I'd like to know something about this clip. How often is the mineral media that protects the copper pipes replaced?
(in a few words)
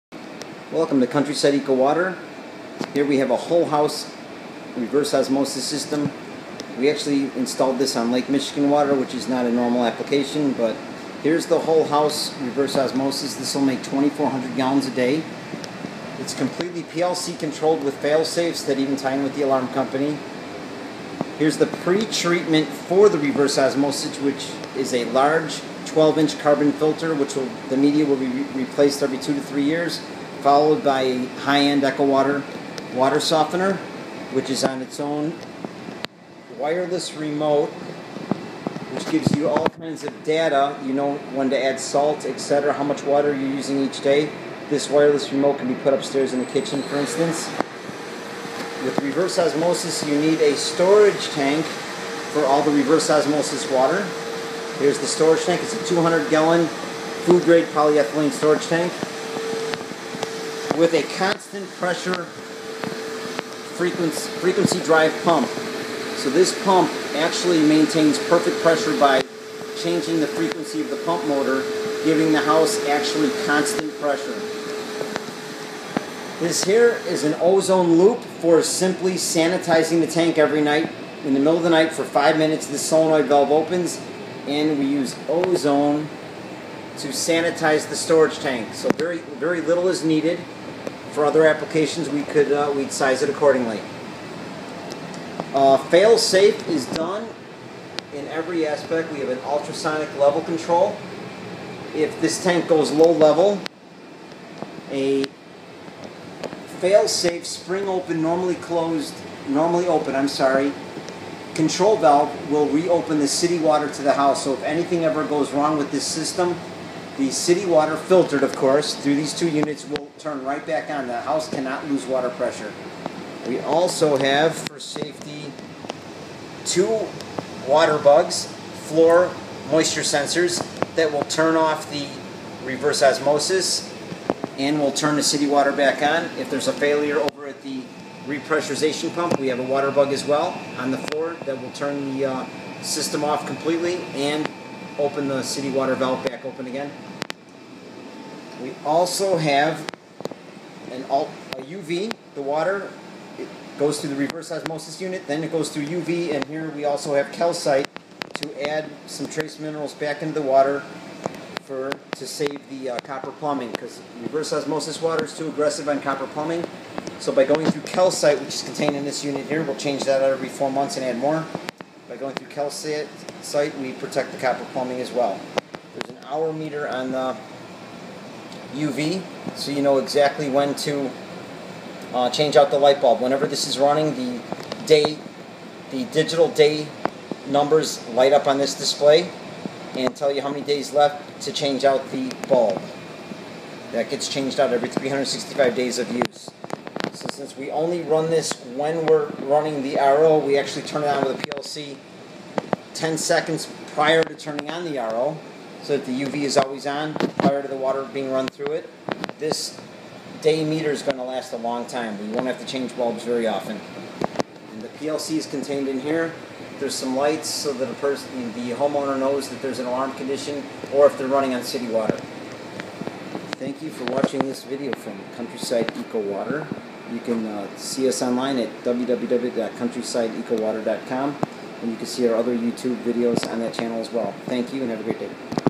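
every 4 months.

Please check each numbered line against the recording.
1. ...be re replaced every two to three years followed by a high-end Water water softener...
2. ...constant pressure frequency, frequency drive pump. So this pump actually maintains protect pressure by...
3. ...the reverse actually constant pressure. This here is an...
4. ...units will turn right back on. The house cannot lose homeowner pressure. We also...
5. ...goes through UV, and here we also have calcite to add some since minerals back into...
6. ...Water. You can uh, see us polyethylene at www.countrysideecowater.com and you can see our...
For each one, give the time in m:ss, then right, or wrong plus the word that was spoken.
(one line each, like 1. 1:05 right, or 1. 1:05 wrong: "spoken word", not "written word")
1. 0:28 right
2. 1:01 wrong: "perfect", not "protect"
3. 1:12 wrong: "house", not "reverse"
4. 1:59 wrong: "water", not "homeowner"
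5. 2:35 wrong: "trace", not "since"
6. 3:46 wrong: "online", not "polyethylene".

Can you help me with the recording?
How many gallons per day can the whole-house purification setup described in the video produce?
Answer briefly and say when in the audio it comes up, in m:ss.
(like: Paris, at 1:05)
2,400, at 0:13.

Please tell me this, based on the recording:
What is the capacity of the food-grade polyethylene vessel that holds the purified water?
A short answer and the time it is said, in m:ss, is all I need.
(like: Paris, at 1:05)
200 gallons, at 0:55.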